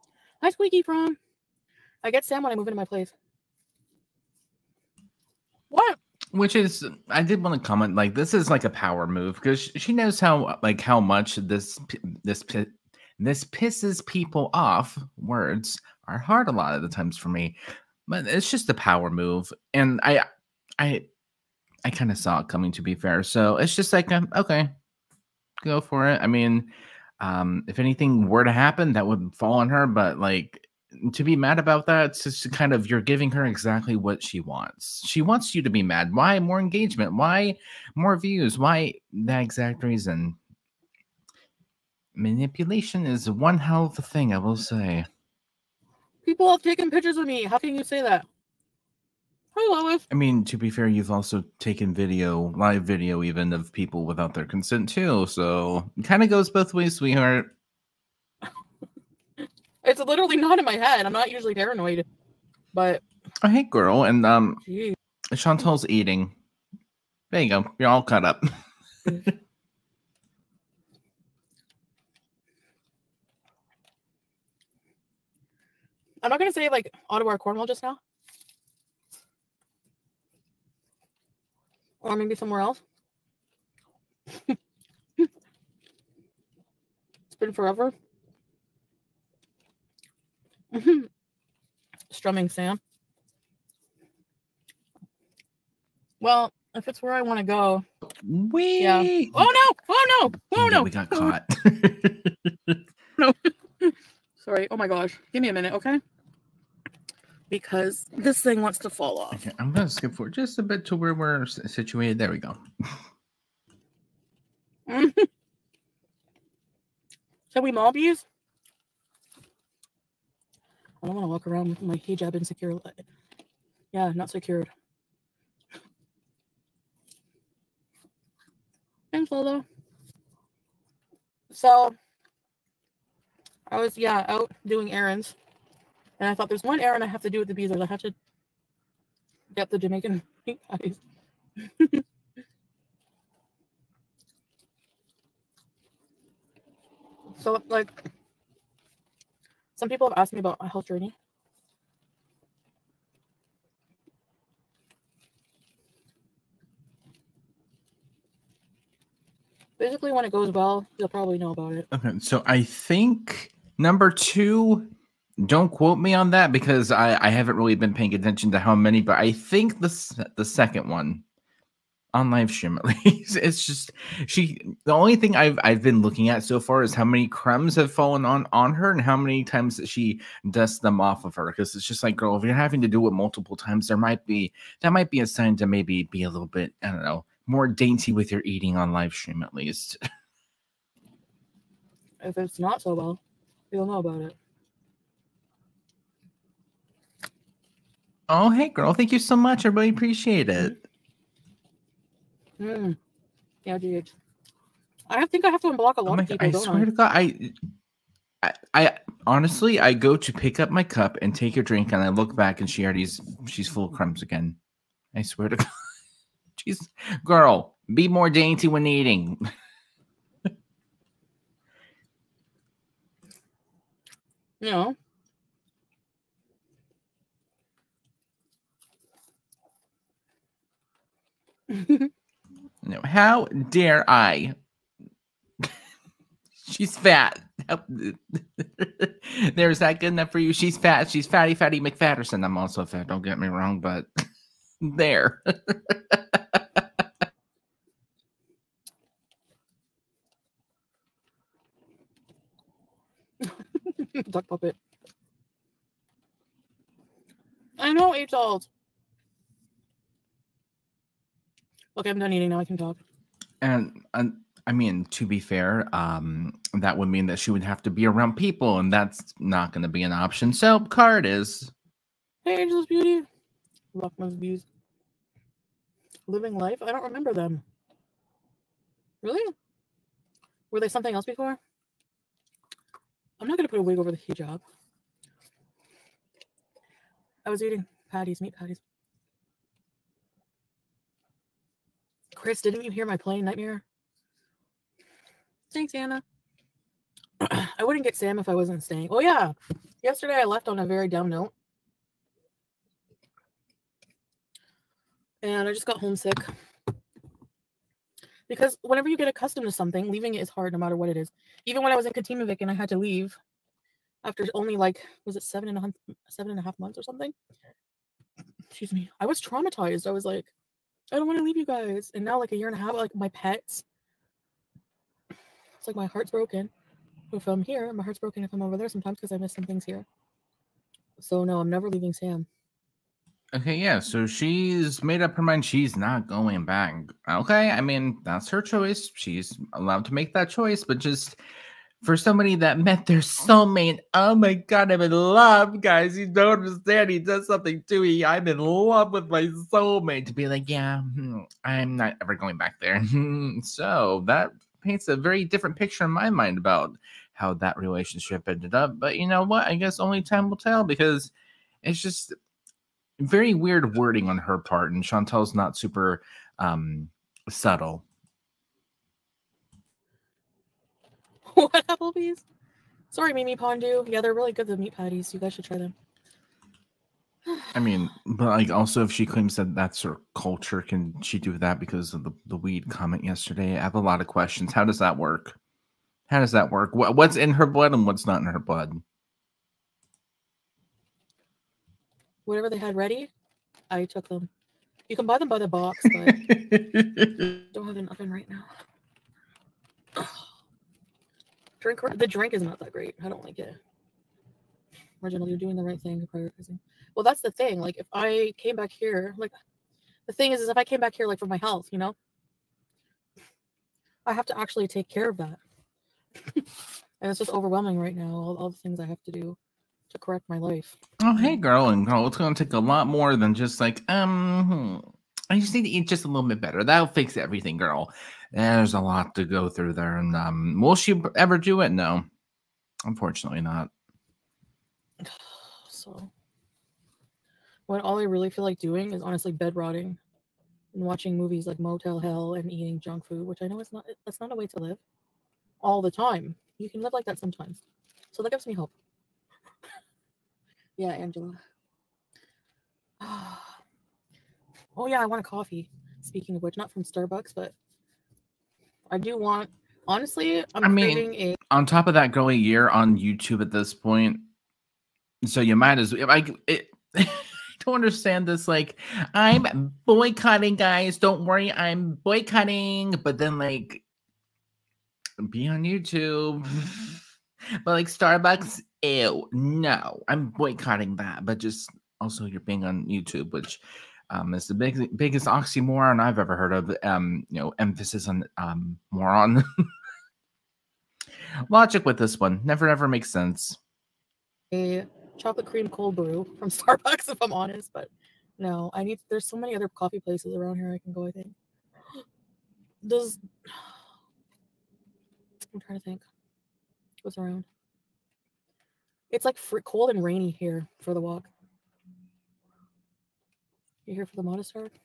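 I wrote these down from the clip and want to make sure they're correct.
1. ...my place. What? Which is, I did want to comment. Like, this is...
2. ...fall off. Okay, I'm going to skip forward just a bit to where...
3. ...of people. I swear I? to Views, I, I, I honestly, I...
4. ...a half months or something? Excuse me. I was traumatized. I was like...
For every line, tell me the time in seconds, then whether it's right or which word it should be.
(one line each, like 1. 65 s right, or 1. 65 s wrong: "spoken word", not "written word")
1. 2 s right
2. 108 s right
3. 206 s wrong: "God", not "Views"
4. 316 s right.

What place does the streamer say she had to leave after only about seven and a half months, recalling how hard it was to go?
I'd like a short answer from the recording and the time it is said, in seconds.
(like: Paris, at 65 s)
Katimovic, at 312 s.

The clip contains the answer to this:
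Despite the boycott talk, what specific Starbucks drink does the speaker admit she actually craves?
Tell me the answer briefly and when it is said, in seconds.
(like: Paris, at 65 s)
Chocolate cream cold brew, at 495 s.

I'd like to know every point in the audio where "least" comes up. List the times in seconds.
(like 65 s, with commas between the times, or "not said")
173 s, 189 s.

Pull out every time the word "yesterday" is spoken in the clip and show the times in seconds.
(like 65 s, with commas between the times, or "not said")
300 s, 383 s.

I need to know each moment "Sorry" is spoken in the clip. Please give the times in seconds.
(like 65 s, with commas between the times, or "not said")
104 s, 373 s.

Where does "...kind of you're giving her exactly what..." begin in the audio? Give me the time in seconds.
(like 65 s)
32 s.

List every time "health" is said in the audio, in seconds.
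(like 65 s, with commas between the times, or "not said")
150 s, 411 s.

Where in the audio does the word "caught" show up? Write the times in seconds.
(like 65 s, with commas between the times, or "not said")
68 s, 101 s.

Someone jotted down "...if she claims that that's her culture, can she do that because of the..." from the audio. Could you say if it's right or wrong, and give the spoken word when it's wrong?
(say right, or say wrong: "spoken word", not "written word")
right.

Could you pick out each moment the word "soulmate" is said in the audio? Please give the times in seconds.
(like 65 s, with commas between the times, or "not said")
343 s, 349 s.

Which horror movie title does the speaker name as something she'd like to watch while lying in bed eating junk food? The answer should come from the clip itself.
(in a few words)
Motel Hell.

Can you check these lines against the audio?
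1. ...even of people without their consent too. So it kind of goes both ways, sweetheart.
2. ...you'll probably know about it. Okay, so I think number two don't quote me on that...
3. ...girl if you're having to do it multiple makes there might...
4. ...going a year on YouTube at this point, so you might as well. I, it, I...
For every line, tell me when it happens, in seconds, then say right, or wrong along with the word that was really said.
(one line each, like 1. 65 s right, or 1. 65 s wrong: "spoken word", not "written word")
1. 53 s right
2. 160 s right
3. 182 s wrong: "times", not "makes"
4. 462 s right.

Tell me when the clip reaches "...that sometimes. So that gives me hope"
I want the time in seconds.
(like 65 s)
447 s.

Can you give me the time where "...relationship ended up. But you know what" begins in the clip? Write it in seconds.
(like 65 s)
357 s.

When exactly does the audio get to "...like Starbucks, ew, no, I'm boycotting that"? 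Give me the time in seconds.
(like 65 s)
477 s.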